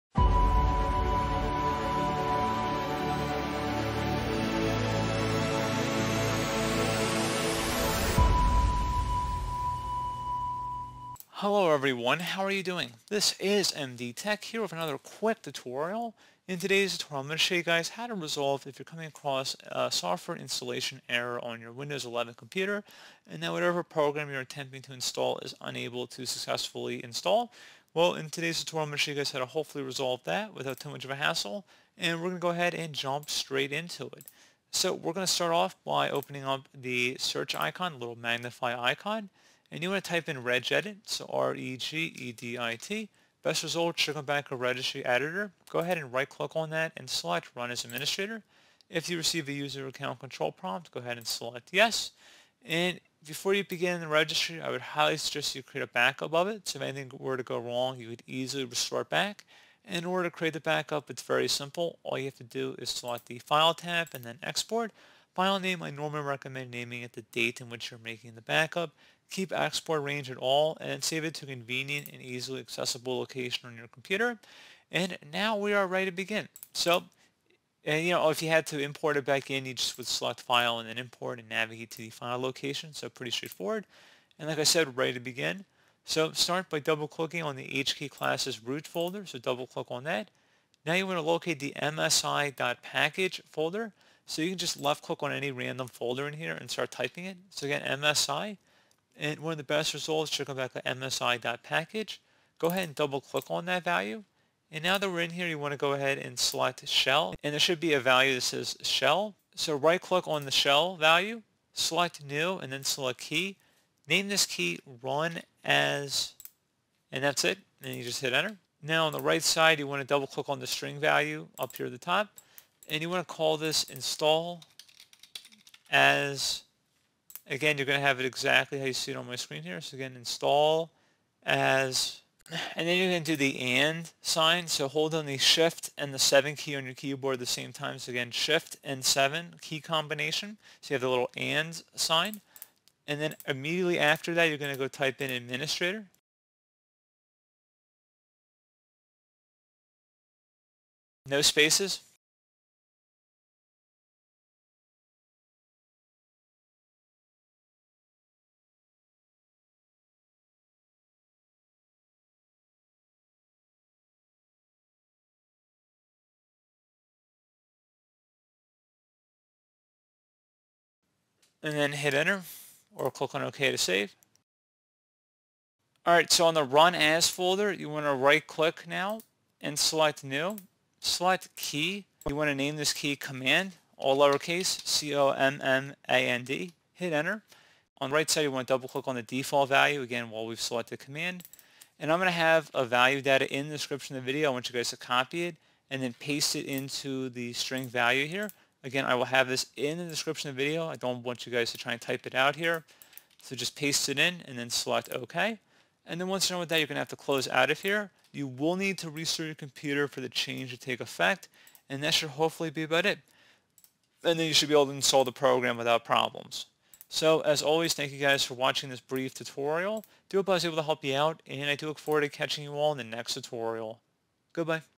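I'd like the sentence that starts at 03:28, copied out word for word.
You will need to restart your computer for the change to take effect, and that should hopefully be about it.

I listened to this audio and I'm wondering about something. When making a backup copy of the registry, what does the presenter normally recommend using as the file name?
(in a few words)
the date.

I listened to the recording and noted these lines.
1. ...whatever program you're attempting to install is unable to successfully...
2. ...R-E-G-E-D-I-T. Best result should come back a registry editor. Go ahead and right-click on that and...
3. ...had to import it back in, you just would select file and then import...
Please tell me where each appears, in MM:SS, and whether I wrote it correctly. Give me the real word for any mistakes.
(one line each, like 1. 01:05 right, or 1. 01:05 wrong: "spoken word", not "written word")
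1. 00:23 right
2. 00:41 right
3. 01:18 right.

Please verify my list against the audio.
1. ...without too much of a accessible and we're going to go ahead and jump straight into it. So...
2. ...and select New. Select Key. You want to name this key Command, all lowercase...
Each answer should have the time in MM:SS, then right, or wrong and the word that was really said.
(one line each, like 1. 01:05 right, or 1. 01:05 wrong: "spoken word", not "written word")
1. 00:30 wrong: "hassle", not "accessible"
2. 02:59 right.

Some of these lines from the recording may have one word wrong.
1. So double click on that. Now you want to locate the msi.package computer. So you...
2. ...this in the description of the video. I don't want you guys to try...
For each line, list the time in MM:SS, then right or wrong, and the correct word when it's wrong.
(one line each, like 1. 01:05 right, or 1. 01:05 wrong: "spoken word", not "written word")
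1. 01:29 wrong: "folder", not "computer"
2. 03:19 right.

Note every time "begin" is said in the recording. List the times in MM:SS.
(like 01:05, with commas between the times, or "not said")
00:53, 01:16, 01:25.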